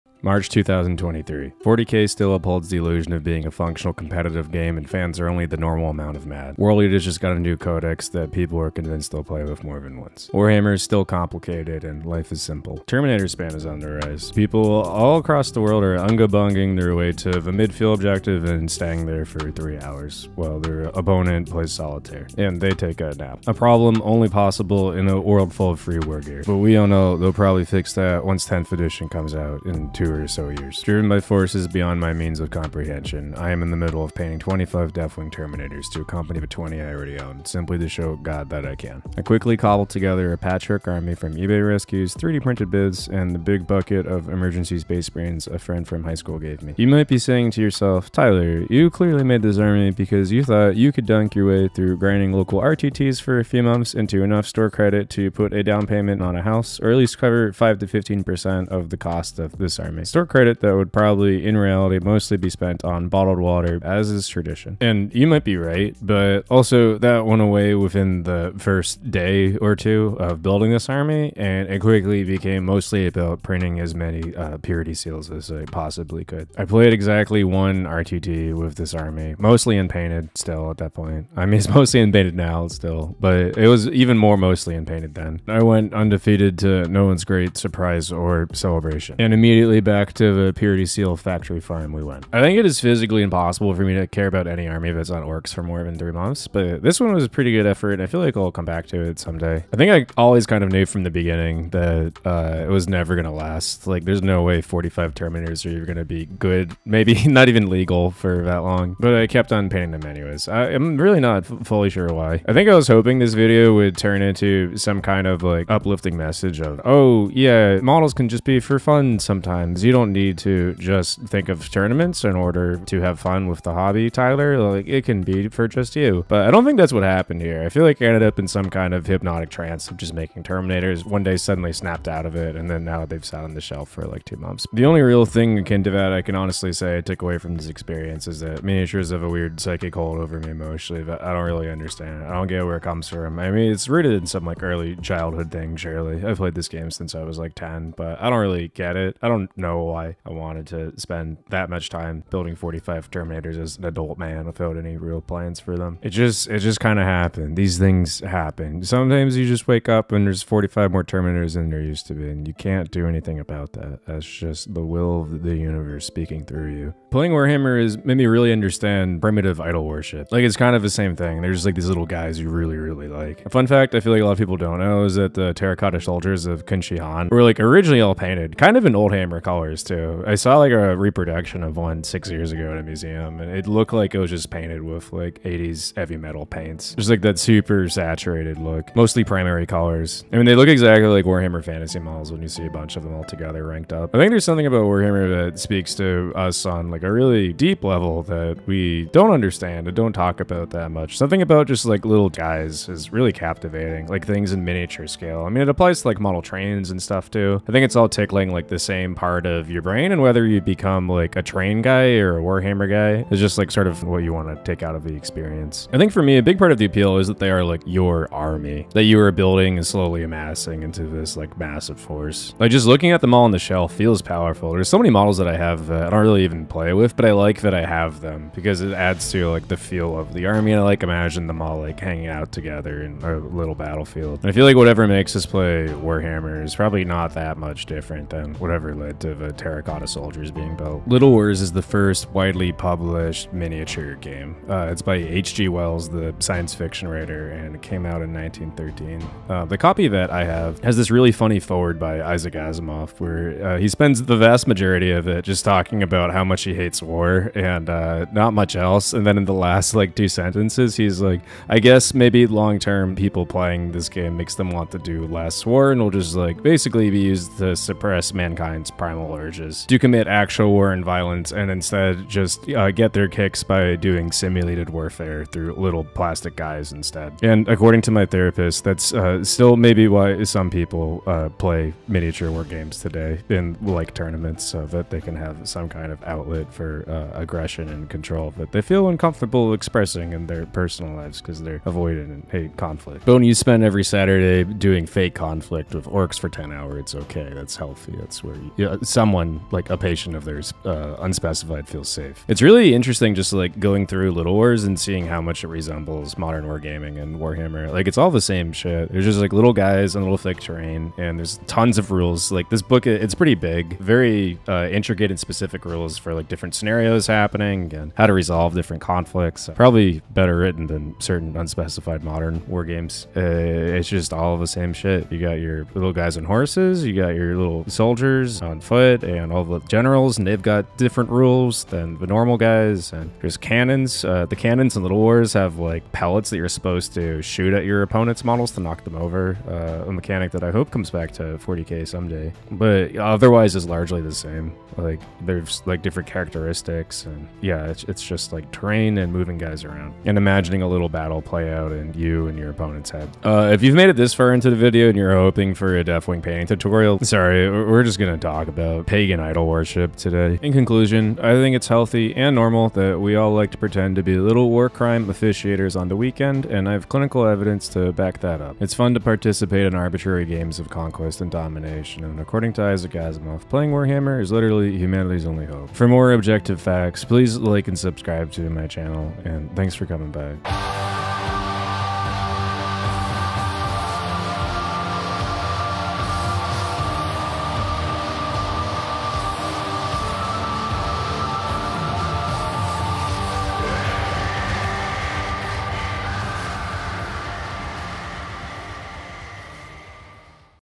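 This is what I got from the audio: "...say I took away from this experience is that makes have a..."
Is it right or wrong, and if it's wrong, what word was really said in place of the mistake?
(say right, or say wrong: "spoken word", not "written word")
wrong: "miniatures", not "makes".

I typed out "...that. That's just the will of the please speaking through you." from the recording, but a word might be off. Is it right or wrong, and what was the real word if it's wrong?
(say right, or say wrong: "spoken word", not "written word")
wrong: "universe", not "please".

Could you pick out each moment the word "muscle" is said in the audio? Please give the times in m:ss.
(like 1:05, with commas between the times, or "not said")
not said.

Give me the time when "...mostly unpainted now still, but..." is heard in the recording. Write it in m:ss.
1:21.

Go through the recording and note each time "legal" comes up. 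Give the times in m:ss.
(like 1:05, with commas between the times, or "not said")
1:47.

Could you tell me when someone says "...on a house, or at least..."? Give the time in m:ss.
0:56.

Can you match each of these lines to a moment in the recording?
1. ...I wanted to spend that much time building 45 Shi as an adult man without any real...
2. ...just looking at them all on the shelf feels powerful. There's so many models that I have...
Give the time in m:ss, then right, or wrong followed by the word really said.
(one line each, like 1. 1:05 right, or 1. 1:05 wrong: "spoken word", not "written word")
1. 2:30 wrong: "Terminators", not "Shi"
2. 3:42 right.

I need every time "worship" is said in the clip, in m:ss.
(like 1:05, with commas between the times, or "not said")
2:49, 5:59.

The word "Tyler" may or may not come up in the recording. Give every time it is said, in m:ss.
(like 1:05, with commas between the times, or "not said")
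0:48, 2:04.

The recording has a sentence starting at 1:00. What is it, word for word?
Store credit, though, would probably, in reality, mostly be spent on bottled water, as is tradition.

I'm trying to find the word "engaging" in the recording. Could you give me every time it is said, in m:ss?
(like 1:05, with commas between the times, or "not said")
not said.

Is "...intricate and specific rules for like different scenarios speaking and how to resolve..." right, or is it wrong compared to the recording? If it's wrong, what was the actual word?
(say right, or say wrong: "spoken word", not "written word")
wrong: "happening", not "speaking".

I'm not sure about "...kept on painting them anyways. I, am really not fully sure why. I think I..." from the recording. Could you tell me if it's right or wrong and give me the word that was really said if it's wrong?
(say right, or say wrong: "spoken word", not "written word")
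right.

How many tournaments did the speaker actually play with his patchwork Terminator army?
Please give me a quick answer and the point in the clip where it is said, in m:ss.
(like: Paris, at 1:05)
1, at 1:16.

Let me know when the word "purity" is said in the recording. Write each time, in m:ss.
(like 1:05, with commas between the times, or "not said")
1:14, 1:30.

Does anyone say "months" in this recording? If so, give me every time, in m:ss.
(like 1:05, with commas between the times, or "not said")
0:53, 1:36, 2:14.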